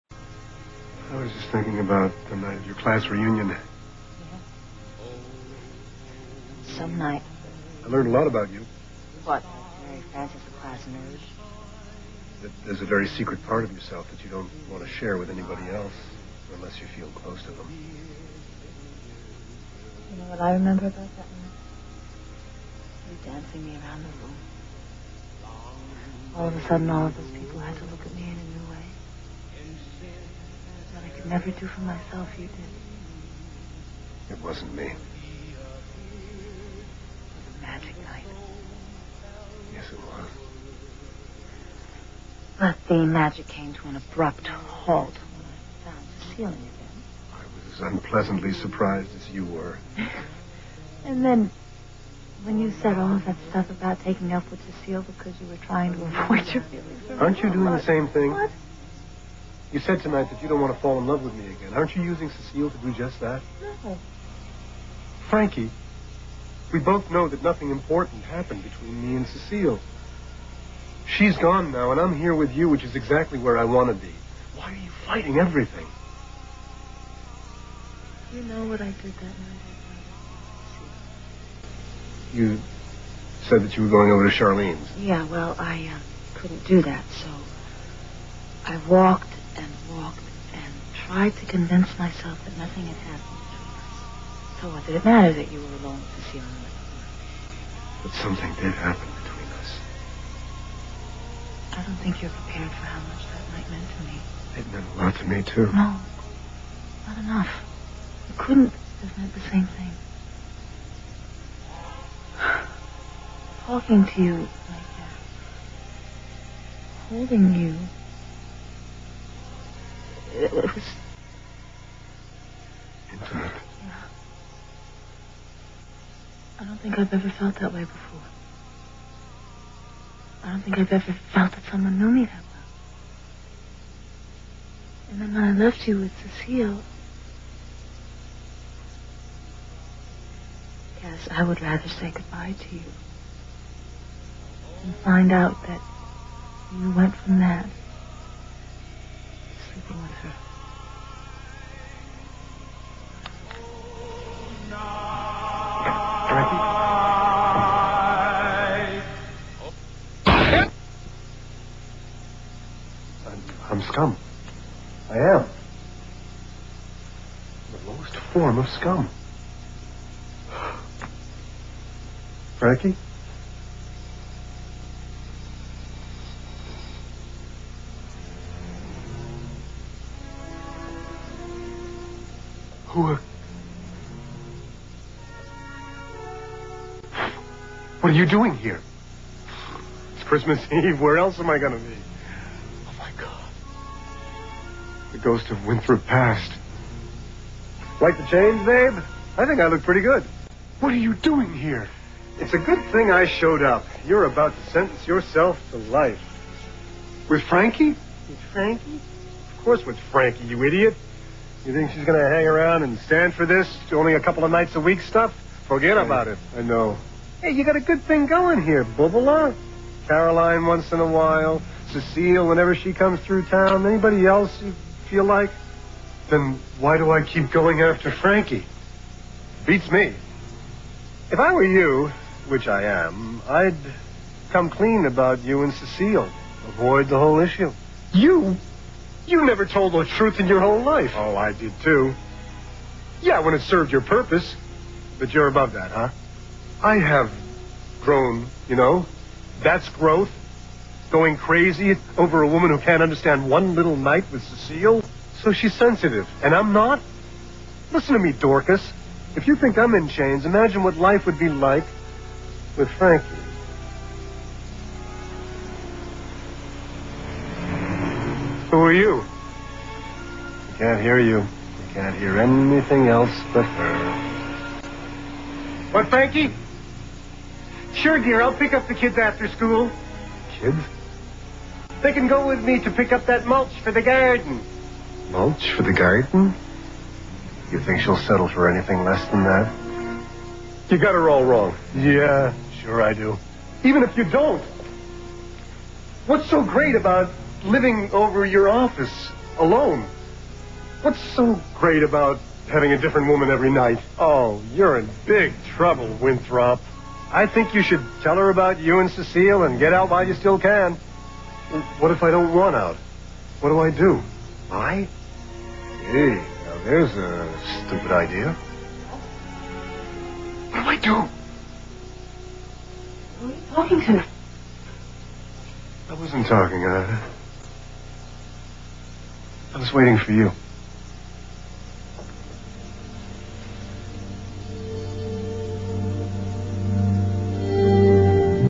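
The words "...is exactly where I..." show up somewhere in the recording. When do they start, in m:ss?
1:12.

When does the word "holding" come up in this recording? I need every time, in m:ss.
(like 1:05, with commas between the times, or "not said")
1:57.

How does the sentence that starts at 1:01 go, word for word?
Aren't you using Cecile to do just that?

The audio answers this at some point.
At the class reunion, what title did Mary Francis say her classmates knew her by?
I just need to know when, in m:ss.
0:10.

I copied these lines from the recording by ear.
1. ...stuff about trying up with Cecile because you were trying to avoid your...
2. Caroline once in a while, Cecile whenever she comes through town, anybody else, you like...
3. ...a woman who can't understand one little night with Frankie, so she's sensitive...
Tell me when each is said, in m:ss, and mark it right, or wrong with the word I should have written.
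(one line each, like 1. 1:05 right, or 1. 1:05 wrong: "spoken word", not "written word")
1. 0:53 wrong: "taking", not "trying"
2. 3:40 right
3. 4:12 wrong: "Cecile", not "Frankie".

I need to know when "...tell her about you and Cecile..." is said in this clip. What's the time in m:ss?
5:08.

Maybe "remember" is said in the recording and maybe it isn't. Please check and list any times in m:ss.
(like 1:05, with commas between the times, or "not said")
0:20.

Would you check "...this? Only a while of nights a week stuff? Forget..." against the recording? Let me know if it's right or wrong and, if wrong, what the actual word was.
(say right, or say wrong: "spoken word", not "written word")
wrong: "couple", not "while".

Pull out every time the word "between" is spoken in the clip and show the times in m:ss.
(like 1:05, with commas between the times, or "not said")
1:08, 1:33, 1:39.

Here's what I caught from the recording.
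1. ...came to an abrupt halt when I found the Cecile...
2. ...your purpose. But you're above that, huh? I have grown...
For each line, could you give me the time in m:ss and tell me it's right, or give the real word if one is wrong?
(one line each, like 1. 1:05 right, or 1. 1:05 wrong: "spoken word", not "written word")
1. 0:43 right
2. 4:03 right.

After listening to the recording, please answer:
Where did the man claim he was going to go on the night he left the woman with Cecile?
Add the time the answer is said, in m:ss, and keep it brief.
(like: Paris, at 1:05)
Charlene's, at 1:24.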